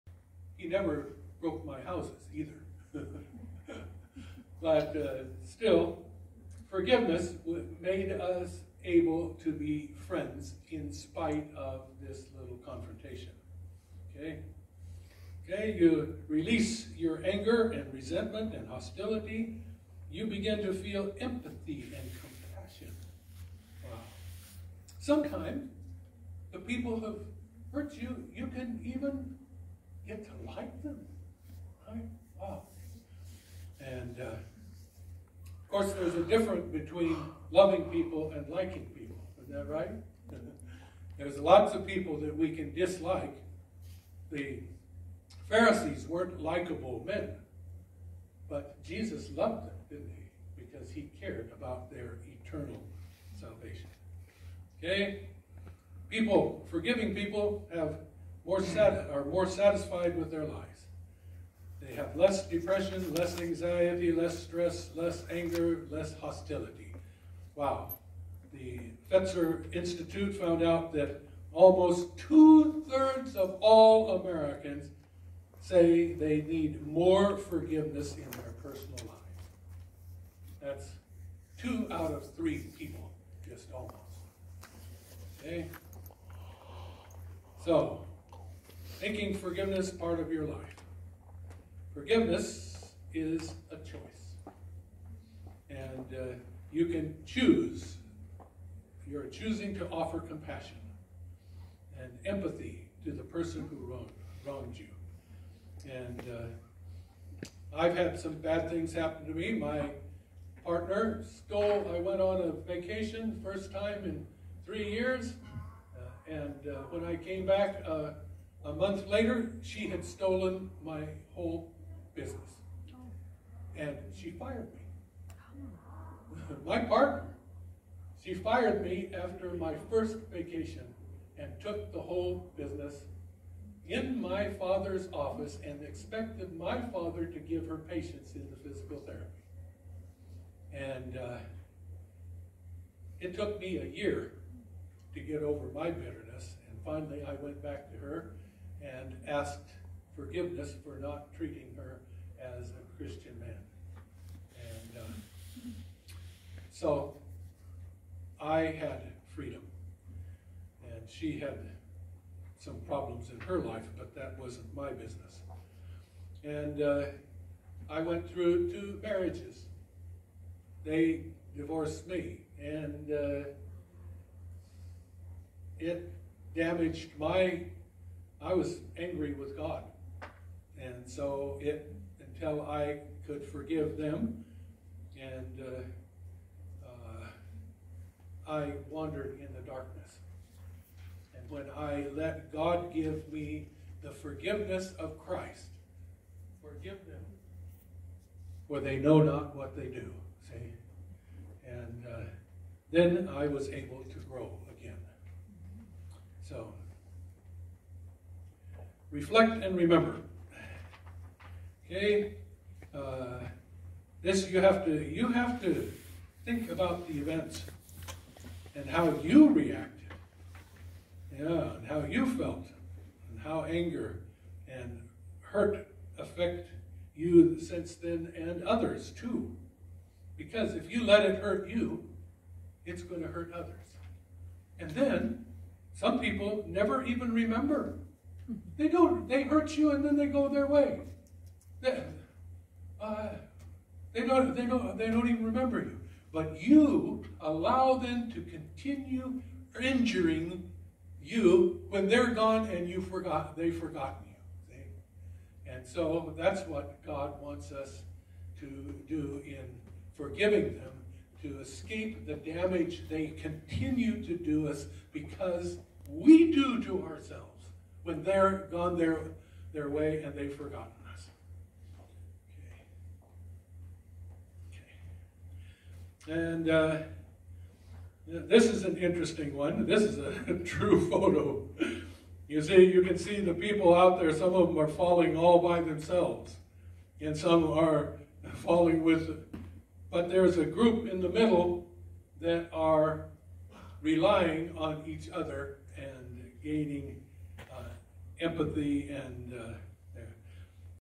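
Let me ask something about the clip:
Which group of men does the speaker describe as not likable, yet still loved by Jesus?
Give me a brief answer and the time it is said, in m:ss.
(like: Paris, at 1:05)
The Pharisees, at 0:44.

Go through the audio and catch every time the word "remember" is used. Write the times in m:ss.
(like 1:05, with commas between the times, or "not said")
3:29, 3:57, 4:05.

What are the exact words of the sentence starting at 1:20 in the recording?
That's two out of three people, just almost.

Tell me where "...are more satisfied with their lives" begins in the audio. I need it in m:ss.
0:58.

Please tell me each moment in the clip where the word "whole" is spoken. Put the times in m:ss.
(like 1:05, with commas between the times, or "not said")
2:01, 2:12.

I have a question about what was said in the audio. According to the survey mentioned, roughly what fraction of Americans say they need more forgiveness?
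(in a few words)
2/3.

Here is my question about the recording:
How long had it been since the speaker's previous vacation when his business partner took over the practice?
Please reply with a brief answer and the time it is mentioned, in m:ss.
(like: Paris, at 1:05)
3 years, at 1:54.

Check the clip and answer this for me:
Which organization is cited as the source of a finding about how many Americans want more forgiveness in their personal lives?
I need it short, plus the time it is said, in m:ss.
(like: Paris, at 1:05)
The Fetzer Institute, at 1:08.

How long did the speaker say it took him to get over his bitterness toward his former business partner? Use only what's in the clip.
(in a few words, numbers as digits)
A year.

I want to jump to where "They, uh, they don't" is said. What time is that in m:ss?
4:01.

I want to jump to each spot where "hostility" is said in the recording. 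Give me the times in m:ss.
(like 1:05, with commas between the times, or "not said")
0:18, 1:06.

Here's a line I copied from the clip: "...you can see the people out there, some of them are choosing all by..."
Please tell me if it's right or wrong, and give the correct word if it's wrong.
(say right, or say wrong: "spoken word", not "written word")
wrong: "falling", not "choosing".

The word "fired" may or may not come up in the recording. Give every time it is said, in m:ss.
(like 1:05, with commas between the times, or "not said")
2:04, 2:08.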